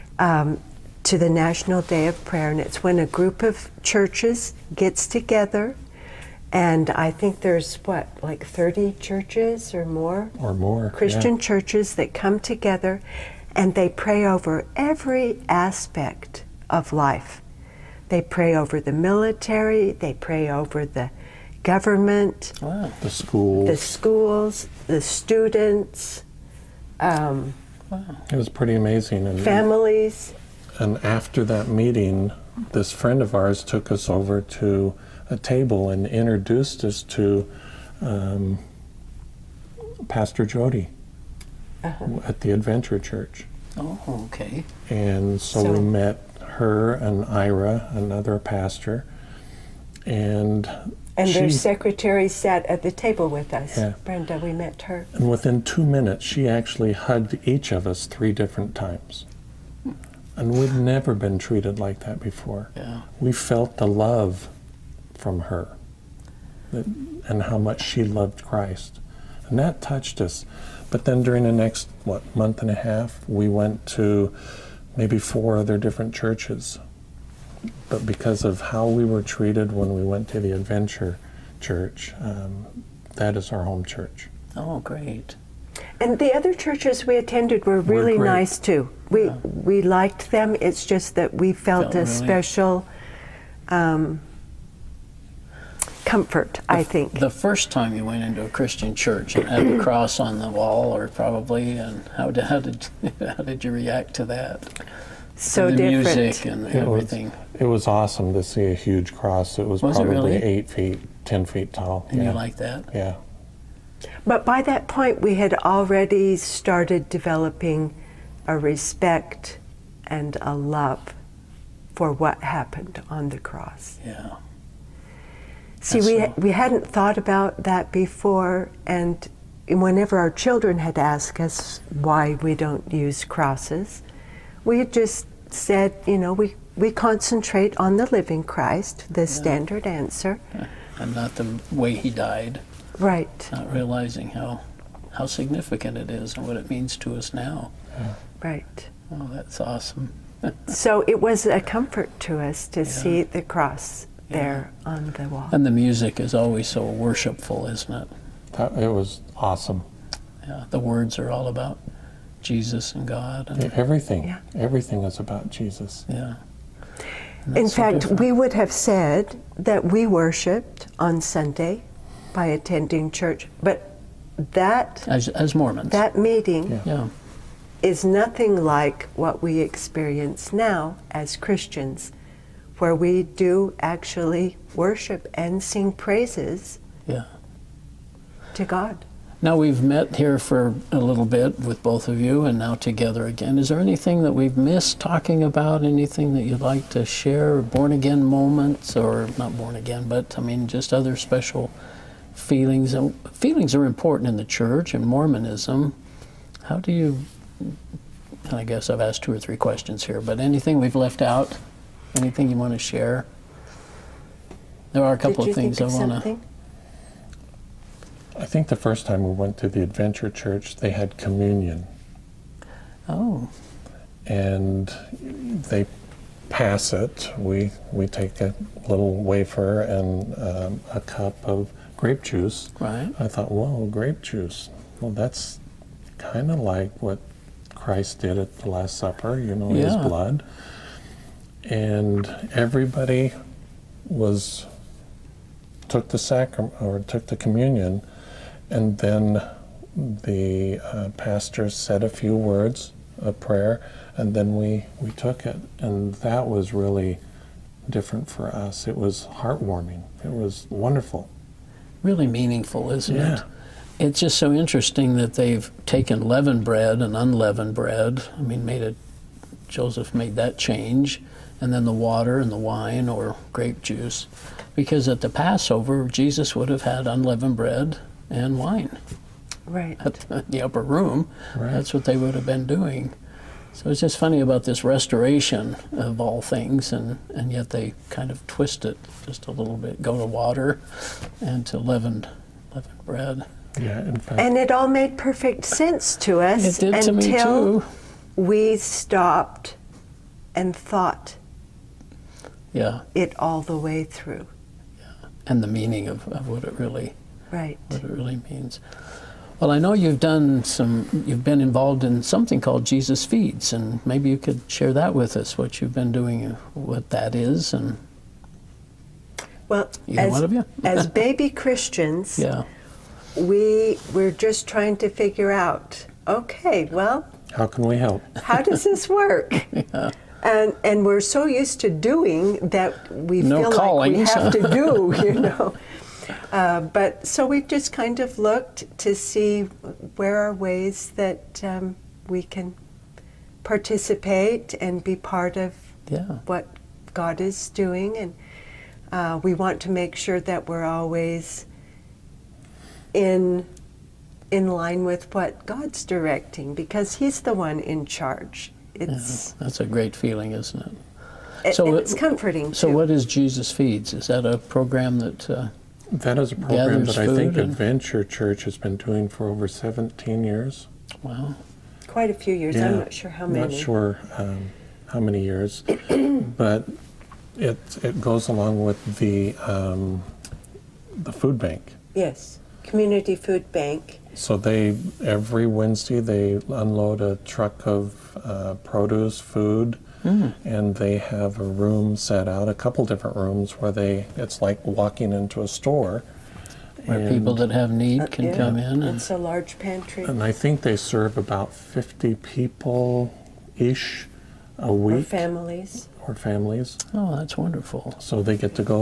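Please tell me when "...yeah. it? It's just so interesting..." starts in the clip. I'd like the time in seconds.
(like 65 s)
263 s.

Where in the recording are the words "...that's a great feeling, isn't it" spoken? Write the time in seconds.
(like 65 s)
359 s.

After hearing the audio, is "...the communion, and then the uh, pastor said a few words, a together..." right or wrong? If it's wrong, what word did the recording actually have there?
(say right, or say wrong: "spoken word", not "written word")
wrong: "prayer", not "together".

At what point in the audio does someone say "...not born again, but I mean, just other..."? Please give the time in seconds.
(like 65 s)
199 s.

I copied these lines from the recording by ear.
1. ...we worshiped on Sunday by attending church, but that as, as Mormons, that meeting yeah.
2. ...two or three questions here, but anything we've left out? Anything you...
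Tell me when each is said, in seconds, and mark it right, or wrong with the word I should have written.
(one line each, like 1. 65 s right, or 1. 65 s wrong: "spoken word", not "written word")
1. 169 s right
2. 209 s right.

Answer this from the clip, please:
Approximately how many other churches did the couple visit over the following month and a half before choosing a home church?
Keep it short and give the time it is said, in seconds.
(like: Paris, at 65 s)
4, at 75 s.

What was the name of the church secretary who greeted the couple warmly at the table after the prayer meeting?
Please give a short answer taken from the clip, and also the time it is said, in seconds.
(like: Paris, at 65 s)
Brenda, at 54 s.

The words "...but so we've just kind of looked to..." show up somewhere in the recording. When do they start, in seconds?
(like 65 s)
336 s.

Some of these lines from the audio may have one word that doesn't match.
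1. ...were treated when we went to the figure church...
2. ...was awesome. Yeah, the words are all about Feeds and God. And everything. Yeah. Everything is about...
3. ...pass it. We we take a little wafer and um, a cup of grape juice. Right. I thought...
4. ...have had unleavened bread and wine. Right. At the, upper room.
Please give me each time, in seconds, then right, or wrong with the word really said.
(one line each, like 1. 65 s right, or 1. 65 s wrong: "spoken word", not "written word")
1. 79 s wrong: "adventure", not "figure"
2. 158 s wrong: "Jesus", not "Feeds"
3. 226 s right
4. 276 s right.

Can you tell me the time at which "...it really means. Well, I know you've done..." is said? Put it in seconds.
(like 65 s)
308 s.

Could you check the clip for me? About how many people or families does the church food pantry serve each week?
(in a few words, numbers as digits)
50.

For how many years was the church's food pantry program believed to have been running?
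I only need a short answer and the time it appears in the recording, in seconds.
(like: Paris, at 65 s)
17 years, at 369 s.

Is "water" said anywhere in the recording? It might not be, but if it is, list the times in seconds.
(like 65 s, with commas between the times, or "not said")
271 s, 290 s.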